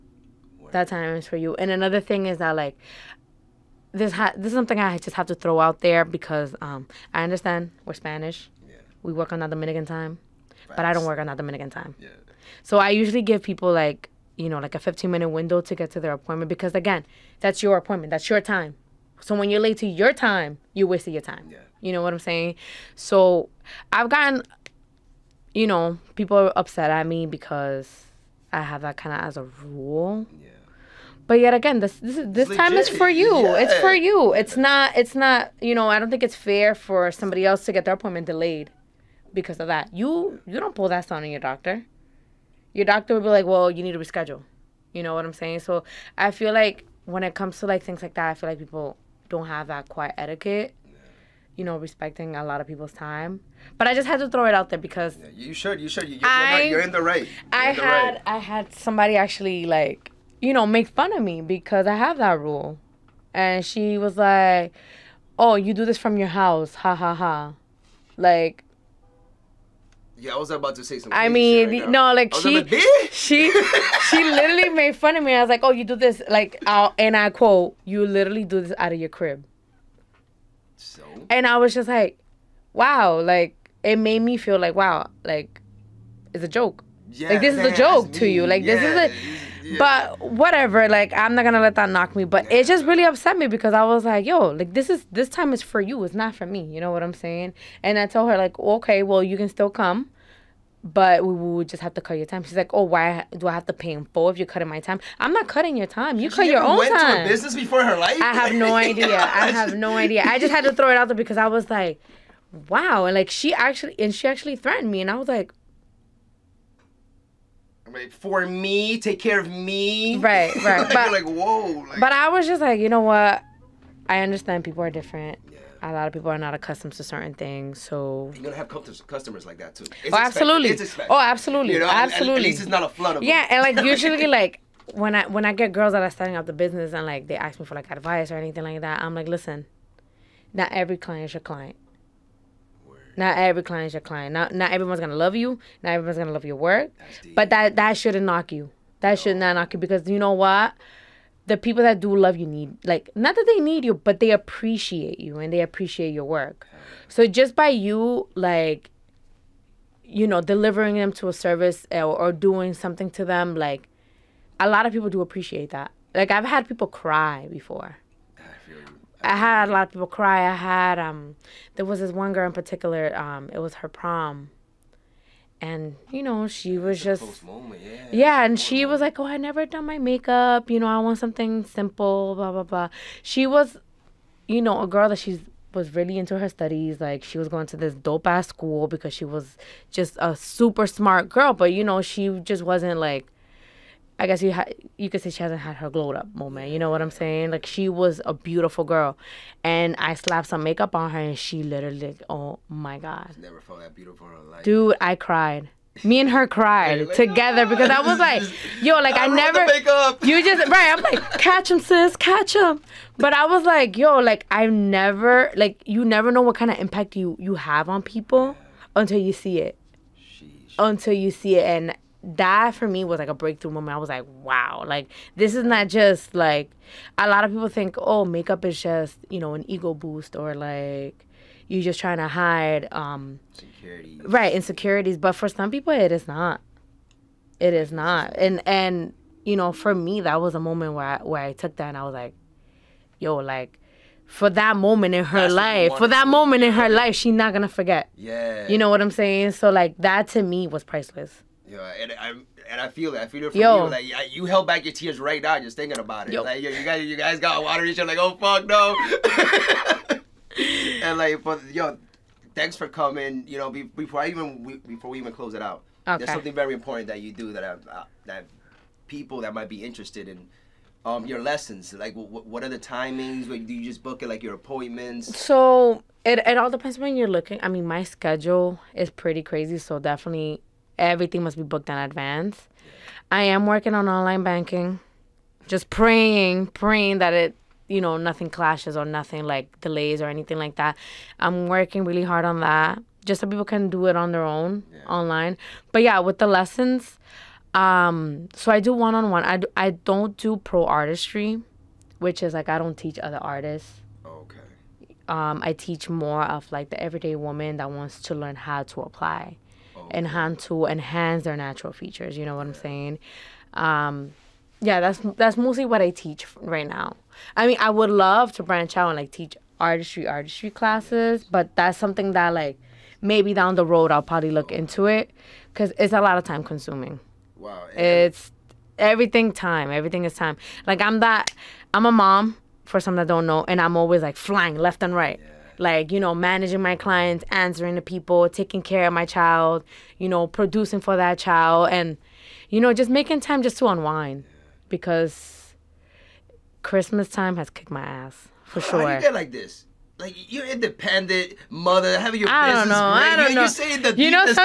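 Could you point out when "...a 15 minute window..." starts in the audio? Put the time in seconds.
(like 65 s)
14 s.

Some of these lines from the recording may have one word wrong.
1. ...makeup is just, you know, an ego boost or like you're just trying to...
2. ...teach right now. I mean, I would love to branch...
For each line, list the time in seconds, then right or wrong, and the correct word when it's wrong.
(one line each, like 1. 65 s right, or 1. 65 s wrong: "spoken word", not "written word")
1. 228 s right
2. 316 s right.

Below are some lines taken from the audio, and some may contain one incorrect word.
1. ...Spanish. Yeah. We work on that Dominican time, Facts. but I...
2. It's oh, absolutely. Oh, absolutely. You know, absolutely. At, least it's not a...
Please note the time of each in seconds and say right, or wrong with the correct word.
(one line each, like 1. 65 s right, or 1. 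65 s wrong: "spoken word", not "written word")
1. 7 s right
2. 130 s right.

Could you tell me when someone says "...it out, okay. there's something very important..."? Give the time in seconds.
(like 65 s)
265 s.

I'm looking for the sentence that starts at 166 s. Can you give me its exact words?
Like I've had people cry before I had a lot of people cry.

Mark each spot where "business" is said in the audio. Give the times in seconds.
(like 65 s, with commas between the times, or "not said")
107 s, 136 s, 352 s.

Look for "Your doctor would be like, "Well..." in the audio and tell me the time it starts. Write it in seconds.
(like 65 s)
42 s.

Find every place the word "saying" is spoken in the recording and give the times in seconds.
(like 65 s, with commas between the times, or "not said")
22 s, 45 s, 97 s, 197 s, 249 s, 312 s, 353 s.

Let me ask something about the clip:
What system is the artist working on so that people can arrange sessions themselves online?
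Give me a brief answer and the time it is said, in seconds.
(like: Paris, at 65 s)
online banking, at 284 s.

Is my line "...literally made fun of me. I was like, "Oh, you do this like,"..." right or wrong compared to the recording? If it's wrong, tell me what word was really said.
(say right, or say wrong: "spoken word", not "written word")
right.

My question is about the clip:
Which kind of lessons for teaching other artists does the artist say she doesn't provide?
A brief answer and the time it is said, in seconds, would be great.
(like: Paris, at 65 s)
pro artistry, at 300 s.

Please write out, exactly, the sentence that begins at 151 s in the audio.
The people that do love you need like not that they need you, but they appreciate you and they appreciate your work.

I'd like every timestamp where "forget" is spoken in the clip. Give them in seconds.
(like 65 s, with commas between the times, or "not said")
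247 s.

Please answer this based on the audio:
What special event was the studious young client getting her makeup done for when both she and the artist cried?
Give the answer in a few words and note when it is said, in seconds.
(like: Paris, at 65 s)
prom, at 173 s.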